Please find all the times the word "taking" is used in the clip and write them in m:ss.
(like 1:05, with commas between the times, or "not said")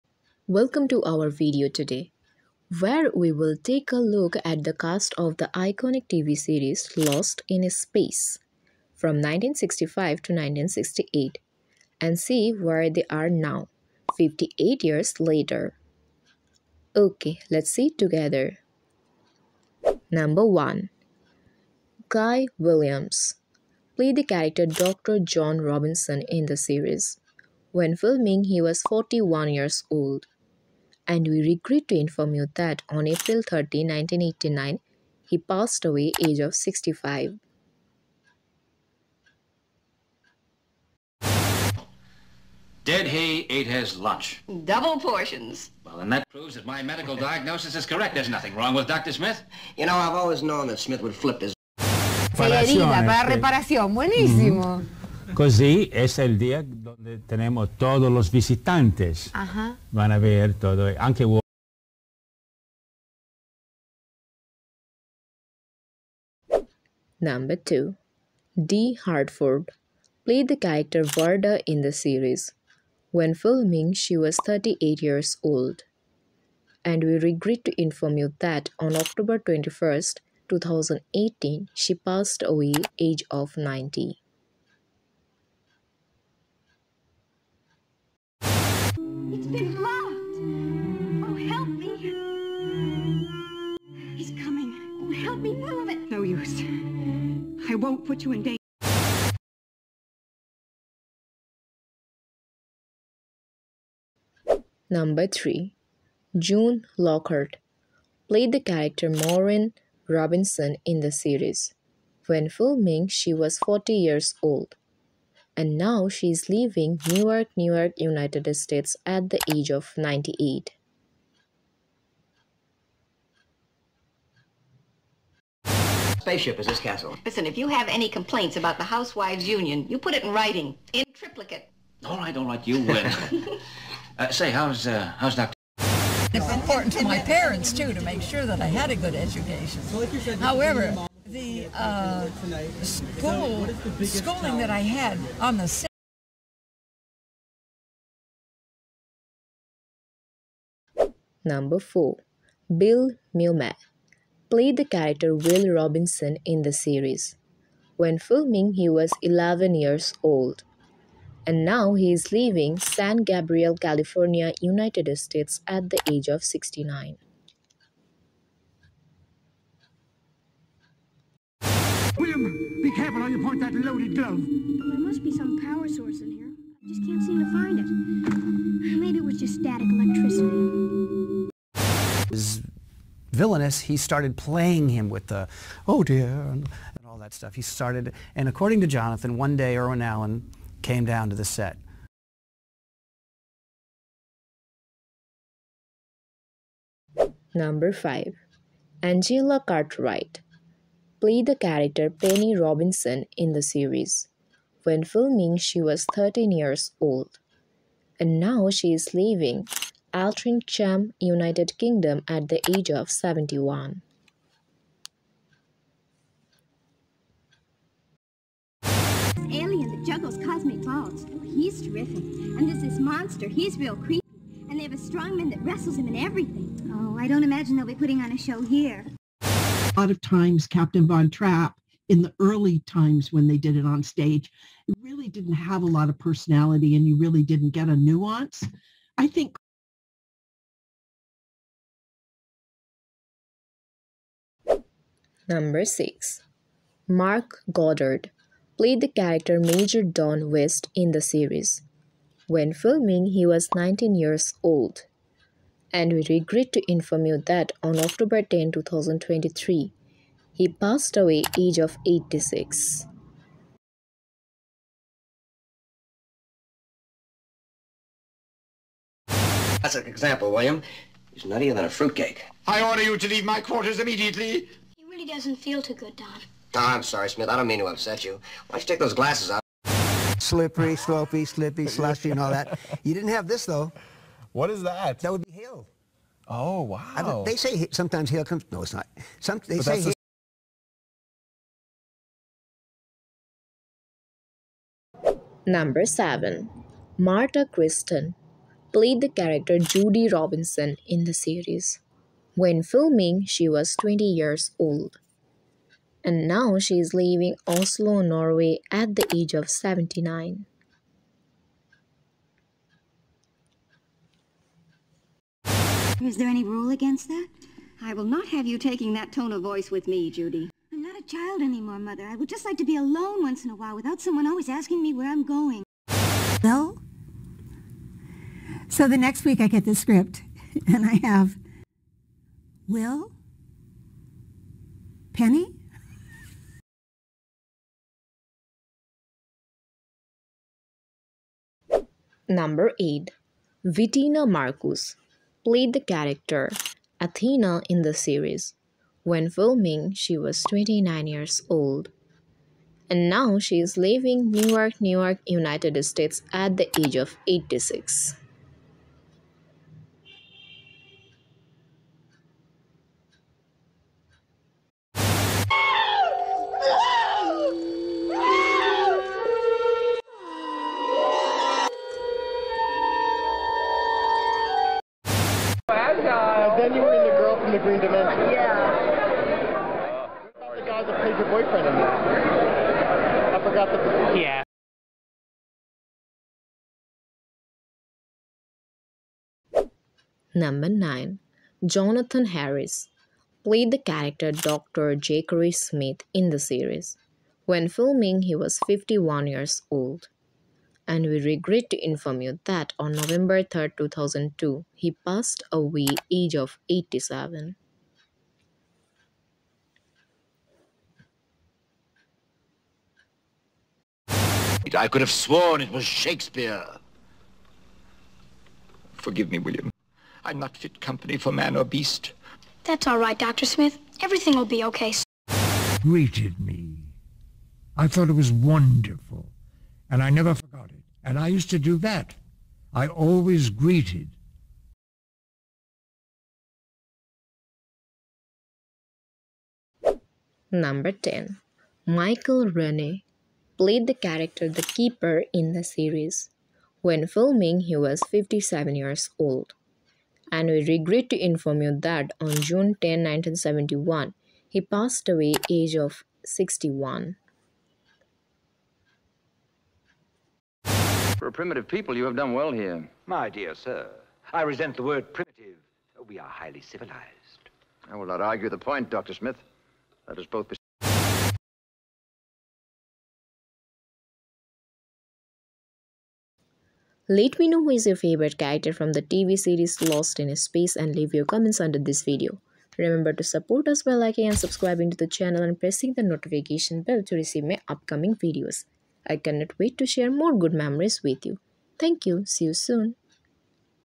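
5:18.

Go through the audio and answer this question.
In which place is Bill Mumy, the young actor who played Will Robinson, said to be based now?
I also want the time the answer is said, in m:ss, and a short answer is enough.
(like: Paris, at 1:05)
San Gabriel, California, at 2:42.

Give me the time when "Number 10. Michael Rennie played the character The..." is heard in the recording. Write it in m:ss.
7:20.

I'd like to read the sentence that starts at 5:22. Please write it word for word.
I would just like to be alone once in a while without someone always asking me where I'm going.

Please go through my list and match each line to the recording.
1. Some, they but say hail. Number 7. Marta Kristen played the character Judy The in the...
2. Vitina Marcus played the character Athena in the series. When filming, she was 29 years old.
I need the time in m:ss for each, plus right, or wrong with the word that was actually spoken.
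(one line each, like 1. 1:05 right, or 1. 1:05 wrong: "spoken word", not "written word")
1. 4:49 wrong: "Robinson", not "The"
2. 5:43 right.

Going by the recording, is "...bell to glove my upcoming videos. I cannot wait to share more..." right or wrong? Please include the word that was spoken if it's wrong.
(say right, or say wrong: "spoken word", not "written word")
wrong: "receive", not "glove".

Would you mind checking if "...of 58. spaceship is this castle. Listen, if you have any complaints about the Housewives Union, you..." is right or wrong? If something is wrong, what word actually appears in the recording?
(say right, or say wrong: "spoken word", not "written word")
wrong: "98", not "58".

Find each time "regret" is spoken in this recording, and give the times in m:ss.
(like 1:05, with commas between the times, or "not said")
0:31, 1:17, 4:16, 6:41, 7:30.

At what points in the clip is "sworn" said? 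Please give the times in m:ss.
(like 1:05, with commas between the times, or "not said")
6:55.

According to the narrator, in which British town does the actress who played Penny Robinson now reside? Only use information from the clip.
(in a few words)
Altrincham.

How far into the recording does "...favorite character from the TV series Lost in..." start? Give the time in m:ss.
7:58.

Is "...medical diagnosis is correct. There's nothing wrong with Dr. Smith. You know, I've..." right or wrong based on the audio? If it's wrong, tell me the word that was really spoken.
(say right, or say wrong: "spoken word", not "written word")
right.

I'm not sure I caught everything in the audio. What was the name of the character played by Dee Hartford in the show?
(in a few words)
Varda.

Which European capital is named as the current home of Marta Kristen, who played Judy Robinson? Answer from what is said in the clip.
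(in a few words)
Oslo.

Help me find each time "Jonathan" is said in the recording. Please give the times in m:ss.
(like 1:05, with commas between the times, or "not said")
3:08, 6:31.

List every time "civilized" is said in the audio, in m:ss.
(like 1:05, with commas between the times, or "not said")
7:46.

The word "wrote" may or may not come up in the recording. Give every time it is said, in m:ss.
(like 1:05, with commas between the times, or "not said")
not said.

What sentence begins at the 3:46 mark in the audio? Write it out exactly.
Oh, I don't imagine they'll be putting on a show here.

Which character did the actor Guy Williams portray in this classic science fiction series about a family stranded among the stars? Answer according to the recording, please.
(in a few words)
Dr. John Robinson.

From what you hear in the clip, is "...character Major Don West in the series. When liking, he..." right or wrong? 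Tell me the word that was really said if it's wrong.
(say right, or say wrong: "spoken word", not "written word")
wrong: "filming", not "liking".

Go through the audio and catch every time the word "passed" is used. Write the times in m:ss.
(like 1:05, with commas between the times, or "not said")
0:35, 1:21, 4:20, 6:45, 7:34.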